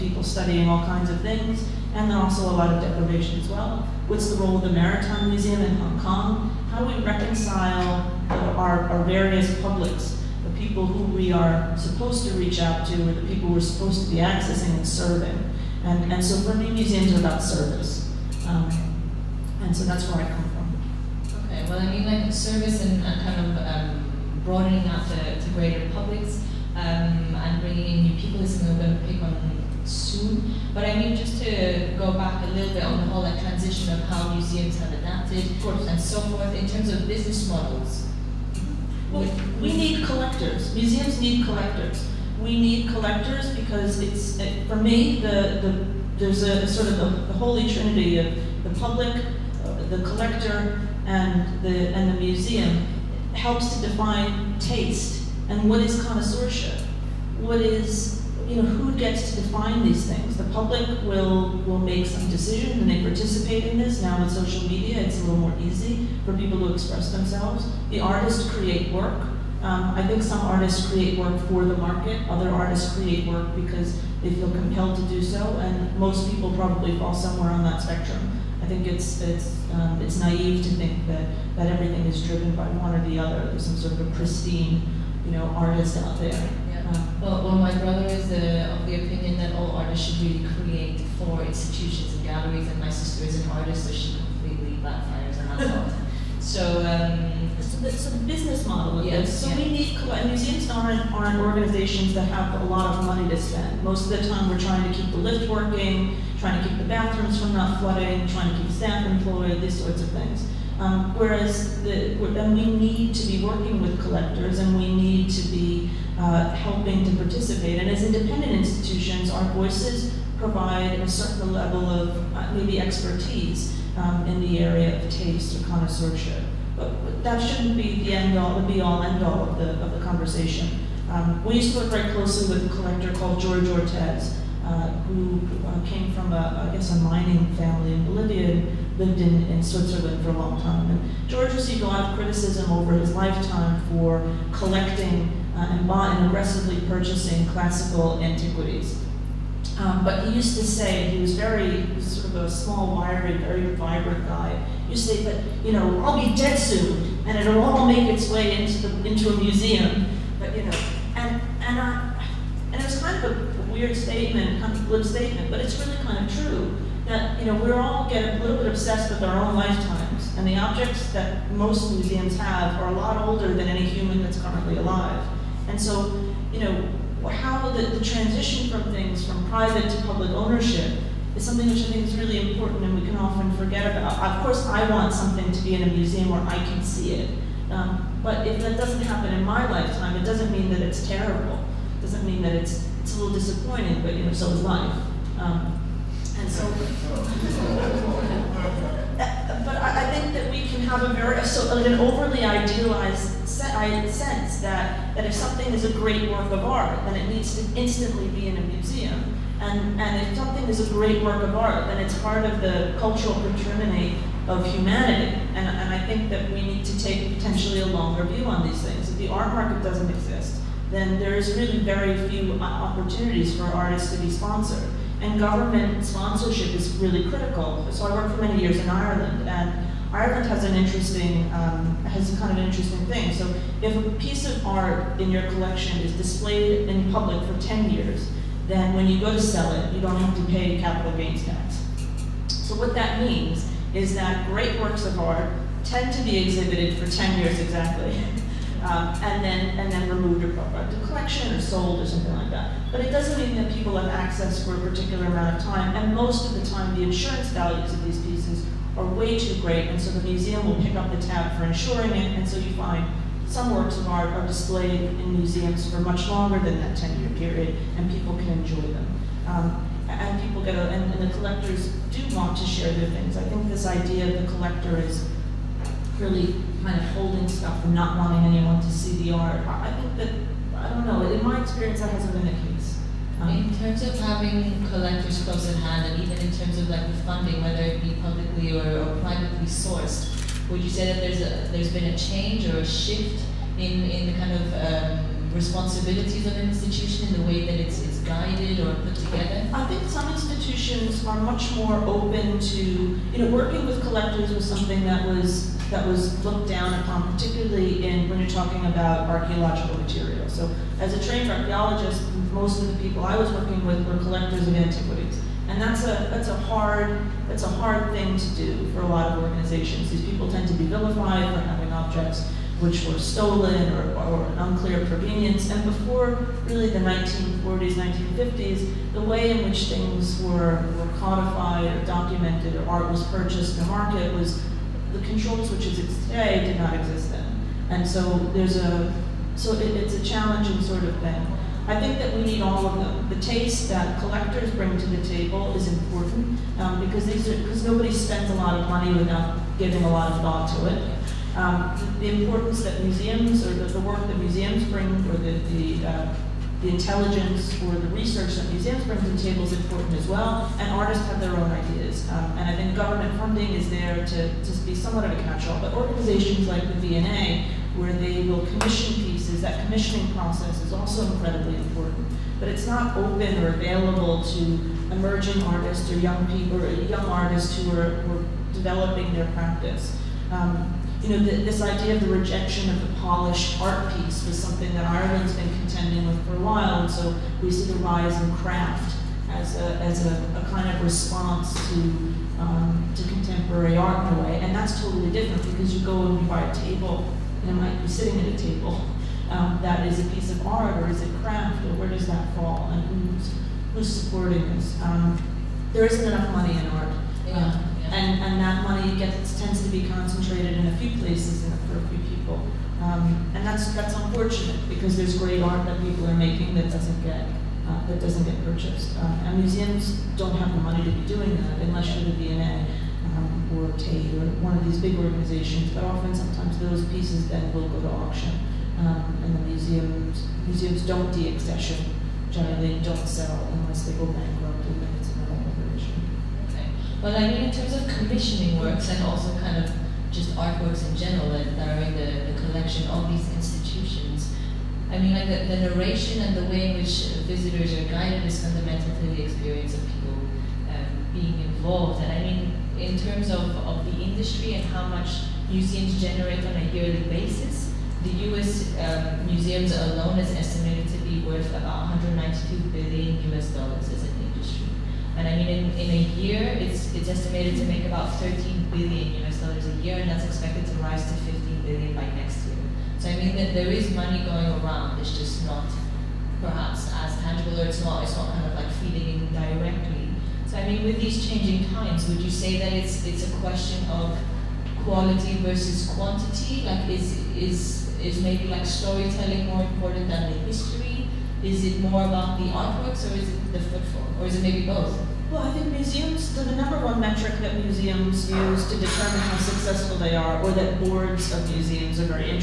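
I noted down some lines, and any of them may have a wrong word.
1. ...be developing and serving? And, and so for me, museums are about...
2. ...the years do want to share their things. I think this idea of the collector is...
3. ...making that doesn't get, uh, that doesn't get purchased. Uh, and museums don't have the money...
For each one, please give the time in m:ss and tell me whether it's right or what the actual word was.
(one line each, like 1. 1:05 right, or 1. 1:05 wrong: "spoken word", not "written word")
1. 0:14 wrong: "accessing", not "developing"
2. 4:31 wrong: "collectors", not "years"
3. 6:56 right.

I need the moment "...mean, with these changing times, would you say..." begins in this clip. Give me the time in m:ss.
8:00.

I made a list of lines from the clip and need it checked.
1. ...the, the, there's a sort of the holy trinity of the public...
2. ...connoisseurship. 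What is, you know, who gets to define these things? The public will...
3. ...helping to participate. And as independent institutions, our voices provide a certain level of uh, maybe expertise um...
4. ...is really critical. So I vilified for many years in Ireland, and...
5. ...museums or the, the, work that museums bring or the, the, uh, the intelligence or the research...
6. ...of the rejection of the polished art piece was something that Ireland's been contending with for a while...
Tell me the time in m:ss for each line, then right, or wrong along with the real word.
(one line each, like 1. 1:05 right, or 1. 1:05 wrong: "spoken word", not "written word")
1. 0:45 right
2. 0:56 right
3. 1:56 right
4. 3:46 wrong: "worked", not "vilified"
5. 5:53 right
6. 6:22 right.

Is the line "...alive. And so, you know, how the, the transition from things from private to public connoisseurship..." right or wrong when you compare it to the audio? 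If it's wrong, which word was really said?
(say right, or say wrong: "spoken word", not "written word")
wrong: "ownership", not "connoisseurship".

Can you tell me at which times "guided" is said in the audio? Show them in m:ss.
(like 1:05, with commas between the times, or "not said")
4:58, 7:28.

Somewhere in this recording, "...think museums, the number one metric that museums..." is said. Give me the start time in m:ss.
8:15.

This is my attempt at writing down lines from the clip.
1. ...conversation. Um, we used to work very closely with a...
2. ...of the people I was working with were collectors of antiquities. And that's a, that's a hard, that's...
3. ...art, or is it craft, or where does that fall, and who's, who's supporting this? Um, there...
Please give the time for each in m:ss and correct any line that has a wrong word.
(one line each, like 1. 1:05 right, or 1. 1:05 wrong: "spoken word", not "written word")
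1. 2:09 right
2. 5:12 right
3. 6:40 right.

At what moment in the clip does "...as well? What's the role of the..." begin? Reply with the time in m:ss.
0:03.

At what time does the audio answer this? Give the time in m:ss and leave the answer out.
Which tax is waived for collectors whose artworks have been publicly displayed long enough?
4:00.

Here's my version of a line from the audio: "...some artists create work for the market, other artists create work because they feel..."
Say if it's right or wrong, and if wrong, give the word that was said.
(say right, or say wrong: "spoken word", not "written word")
right.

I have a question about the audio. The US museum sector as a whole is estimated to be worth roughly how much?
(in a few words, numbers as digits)
192 billion US dollars.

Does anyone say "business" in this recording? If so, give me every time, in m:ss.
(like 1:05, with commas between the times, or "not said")
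0:37, 1:38.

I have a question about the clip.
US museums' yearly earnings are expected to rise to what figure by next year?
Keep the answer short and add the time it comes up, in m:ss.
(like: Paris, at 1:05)
15 billion, at 7:51.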